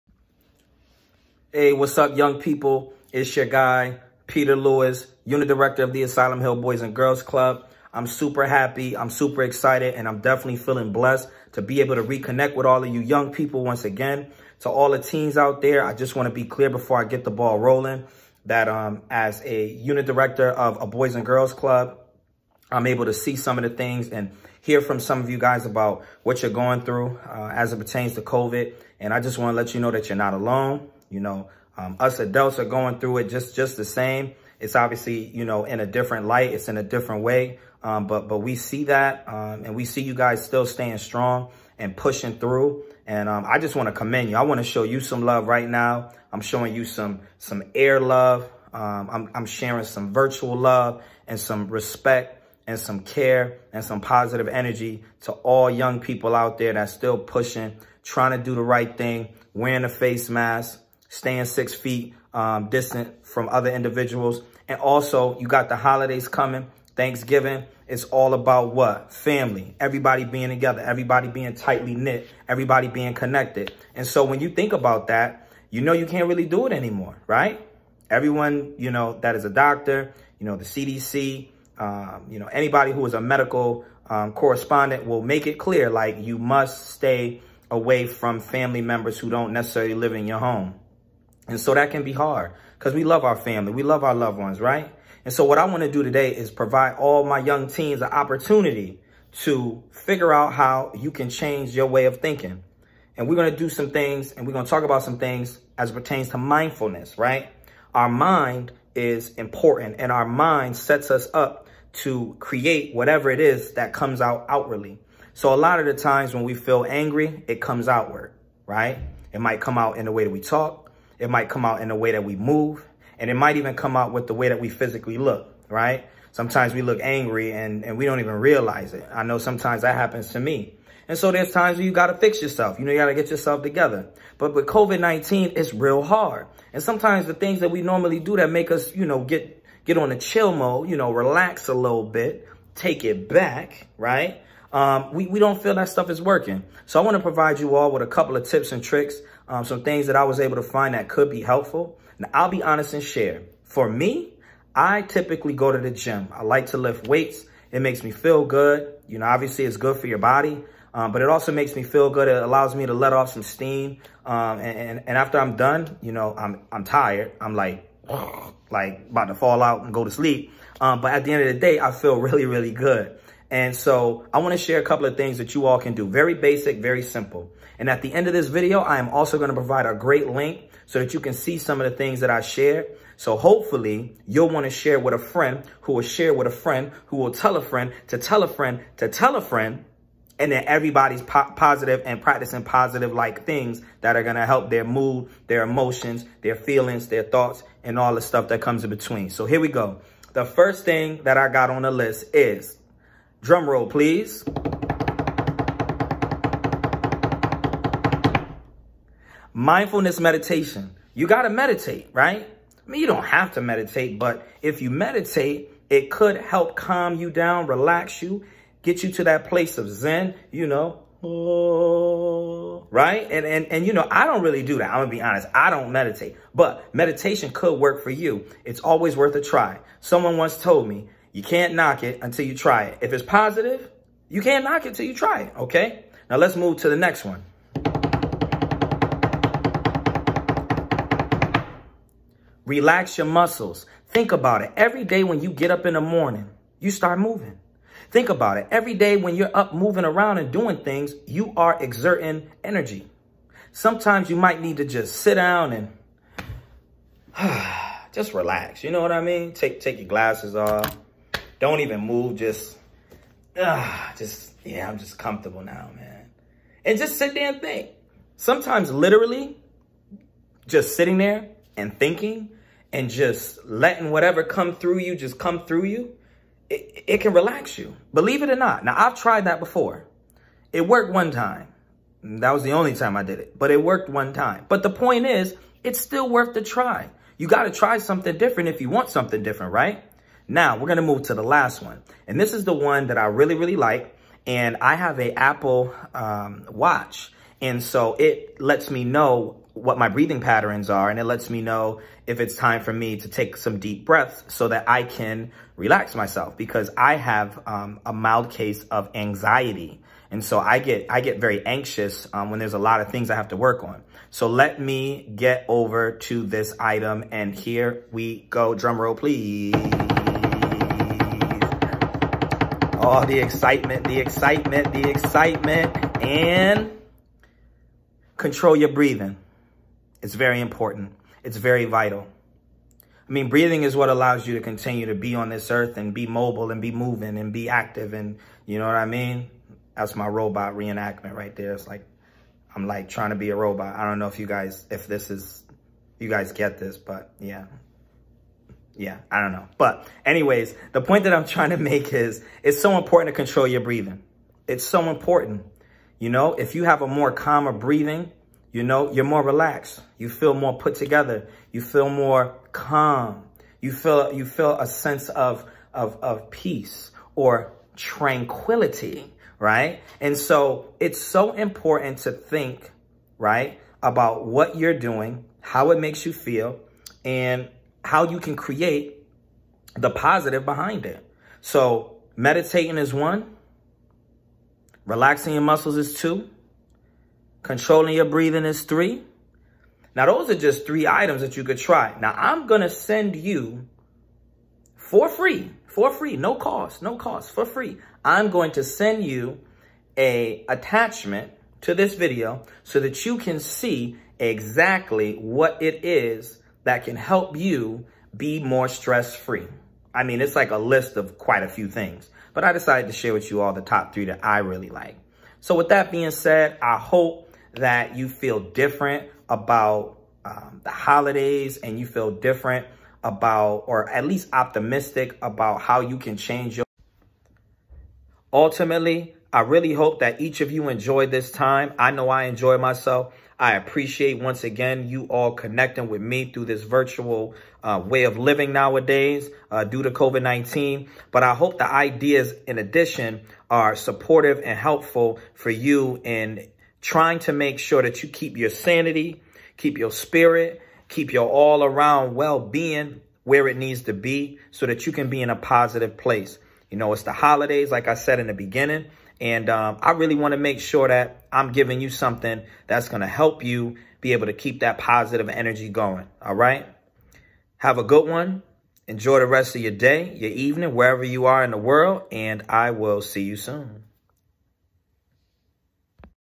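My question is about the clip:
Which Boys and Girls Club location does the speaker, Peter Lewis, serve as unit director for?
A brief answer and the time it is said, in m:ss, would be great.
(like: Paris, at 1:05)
Asylum Hill, at 0:06.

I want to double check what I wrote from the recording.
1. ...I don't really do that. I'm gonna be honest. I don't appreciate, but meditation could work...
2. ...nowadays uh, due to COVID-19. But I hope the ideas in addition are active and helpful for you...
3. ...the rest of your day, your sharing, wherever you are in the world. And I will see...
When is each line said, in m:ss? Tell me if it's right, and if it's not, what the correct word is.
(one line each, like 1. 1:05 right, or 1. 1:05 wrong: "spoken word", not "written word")
1. 3:44 wrong: "meditate", not "appreciate"
2. 7:18 wrong: "supportive", not "active"
3. 7:49 wrong: "evening", not "sharing".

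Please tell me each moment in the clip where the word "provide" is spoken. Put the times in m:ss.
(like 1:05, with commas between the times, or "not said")
1:36, 2:27, 2:59.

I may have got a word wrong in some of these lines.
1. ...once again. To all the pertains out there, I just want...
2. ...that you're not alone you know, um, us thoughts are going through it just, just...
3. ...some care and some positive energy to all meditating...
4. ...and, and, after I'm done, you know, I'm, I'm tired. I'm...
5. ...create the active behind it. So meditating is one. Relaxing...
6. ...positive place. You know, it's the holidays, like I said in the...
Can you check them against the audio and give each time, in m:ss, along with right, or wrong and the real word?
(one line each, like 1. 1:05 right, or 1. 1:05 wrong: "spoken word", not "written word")
1. 0:13 wrong: "teens", not "pertains"
2. 0:29 wrong: "adults", not "thoughts"
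3. 0:52 wrong: "young", not "meditating"
4. 2:44 right
5. 6:18 wrong: "positive", not "active"
6. 7:35 right.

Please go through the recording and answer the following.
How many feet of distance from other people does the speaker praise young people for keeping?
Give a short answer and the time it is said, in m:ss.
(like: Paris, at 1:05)
6, at 1:01.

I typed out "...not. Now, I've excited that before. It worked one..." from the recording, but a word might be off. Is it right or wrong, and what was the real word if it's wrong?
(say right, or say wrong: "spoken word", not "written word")
wrong: "tried", not "excited".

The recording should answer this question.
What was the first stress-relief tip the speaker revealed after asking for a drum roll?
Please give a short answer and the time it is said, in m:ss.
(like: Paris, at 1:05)
Mindfulness meditation, at 3:29.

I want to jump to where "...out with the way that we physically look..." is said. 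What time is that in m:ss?
2:03.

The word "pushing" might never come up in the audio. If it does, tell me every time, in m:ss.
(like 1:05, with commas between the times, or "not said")
0:41, 0:57.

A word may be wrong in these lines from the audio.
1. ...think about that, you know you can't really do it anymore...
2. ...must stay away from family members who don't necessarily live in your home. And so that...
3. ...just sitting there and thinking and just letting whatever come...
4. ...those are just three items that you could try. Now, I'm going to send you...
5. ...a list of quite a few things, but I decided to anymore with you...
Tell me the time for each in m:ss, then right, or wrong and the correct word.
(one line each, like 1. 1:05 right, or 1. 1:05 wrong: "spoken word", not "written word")
1. 1:14 right
2. 1:26 right
3. 4:30 right
4. 6:30 right
5. 6:50 wrong: "share", not "anymore".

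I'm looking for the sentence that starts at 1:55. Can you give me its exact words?
So a lot of the times when we feel angry, it comes outward, right?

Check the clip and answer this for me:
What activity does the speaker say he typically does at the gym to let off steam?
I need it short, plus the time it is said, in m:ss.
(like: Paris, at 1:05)
lift weights, at 2:36.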